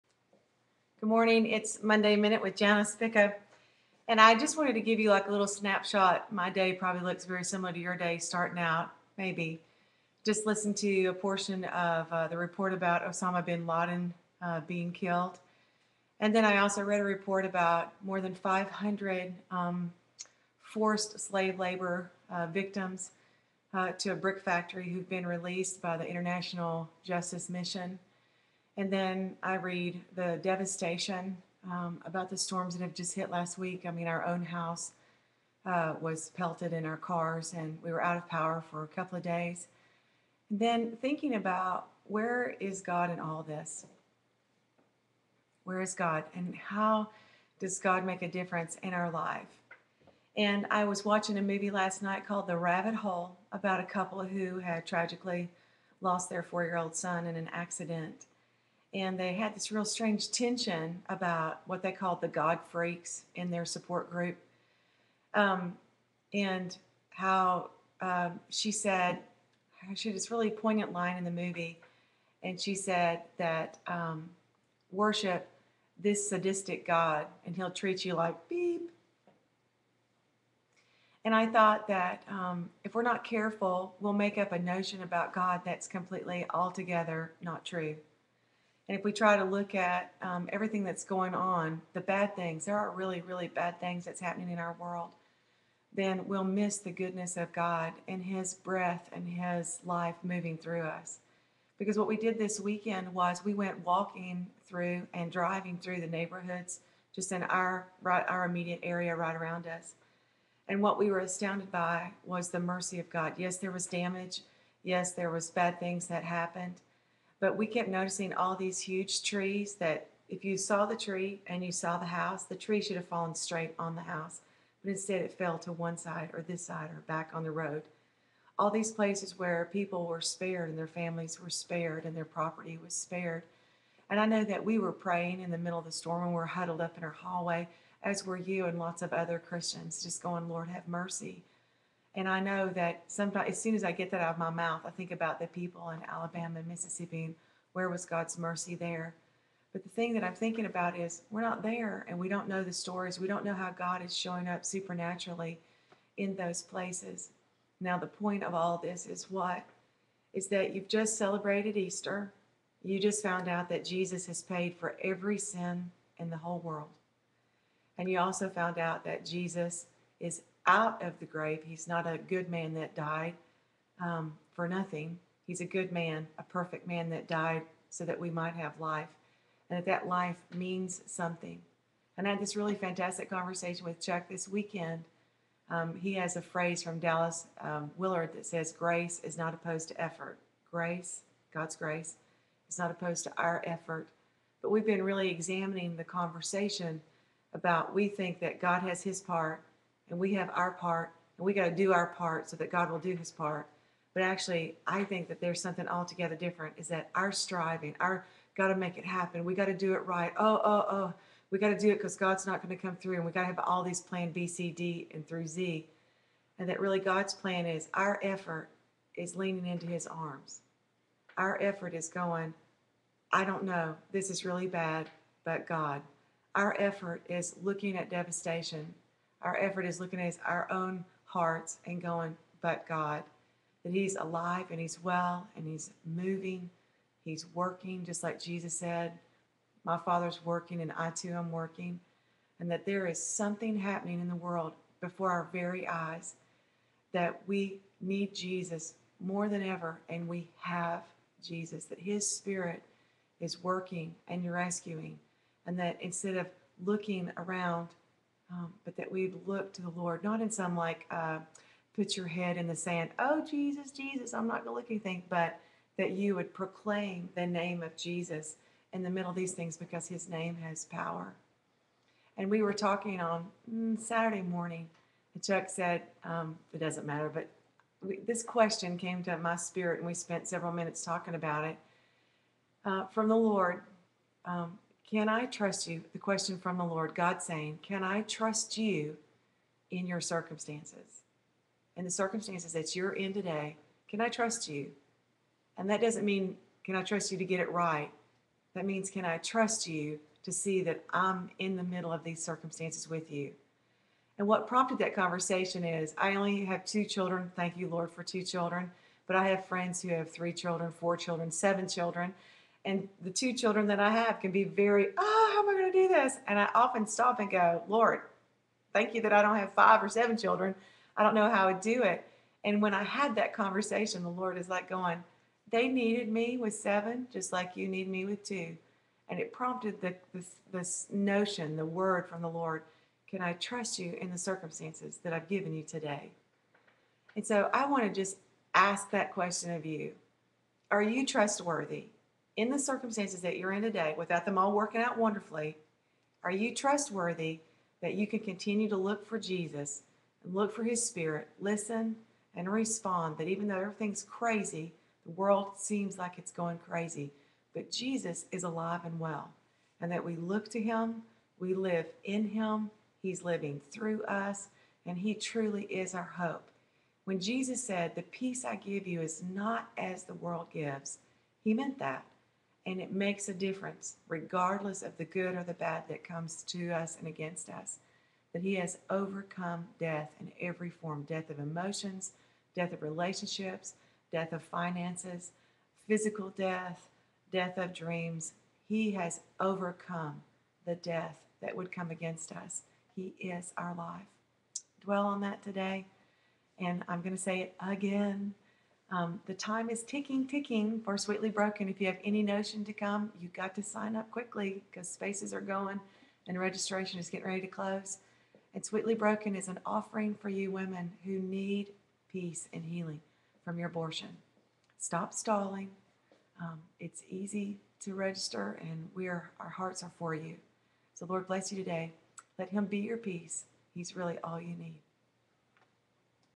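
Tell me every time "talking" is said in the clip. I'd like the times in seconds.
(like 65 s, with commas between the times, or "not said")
272 s, 281 s.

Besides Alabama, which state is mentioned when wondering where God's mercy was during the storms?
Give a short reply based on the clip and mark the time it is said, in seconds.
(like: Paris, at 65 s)
Mississippi, at 146 s.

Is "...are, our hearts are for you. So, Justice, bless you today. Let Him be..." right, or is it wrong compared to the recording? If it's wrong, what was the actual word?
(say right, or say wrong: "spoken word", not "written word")
wrong: "Lord", not "Justice".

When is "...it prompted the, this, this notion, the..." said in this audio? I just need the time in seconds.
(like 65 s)
329 s.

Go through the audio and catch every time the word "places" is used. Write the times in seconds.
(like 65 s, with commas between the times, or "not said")
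128 s, 156 s.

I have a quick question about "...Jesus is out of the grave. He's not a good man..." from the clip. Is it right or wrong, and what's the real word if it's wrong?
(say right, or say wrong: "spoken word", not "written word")
right.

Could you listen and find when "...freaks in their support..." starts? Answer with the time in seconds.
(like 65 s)
62 s.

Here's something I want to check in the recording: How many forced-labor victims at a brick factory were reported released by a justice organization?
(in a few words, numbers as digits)
More than 500.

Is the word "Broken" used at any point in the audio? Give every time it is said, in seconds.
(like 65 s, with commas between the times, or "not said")
401 s, 409 s.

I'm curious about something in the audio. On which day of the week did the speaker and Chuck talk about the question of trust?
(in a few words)
Saturday.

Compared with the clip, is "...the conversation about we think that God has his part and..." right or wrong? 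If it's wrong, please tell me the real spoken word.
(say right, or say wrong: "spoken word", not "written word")
right.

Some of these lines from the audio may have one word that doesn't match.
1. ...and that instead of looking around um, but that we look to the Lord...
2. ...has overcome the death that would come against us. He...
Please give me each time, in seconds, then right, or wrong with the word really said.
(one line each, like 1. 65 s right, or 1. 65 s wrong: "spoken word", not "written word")
1. 255 s right
2. 389 s right.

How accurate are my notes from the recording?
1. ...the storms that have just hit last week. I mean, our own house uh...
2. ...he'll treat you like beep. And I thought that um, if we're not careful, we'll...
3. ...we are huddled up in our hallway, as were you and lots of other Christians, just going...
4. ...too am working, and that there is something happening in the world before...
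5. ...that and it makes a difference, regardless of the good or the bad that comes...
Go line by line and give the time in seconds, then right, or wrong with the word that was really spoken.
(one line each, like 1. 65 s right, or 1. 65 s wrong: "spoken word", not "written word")
1. 32 s right
2. 77 s right
3. 136 s right
4. 241 s right
5. 371 s right.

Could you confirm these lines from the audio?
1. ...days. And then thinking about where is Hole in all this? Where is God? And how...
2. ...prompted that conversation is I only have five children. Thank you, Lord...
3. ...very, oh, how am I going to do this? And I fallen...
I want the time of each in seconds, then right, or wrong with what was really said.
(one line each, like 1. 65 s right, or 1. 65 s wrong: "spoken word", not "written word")
1. 39 s wrong: "God", not "Hole"
2. 304 s wrong: "two", not "five"
3. 314 s wrong: "often", not "fallen".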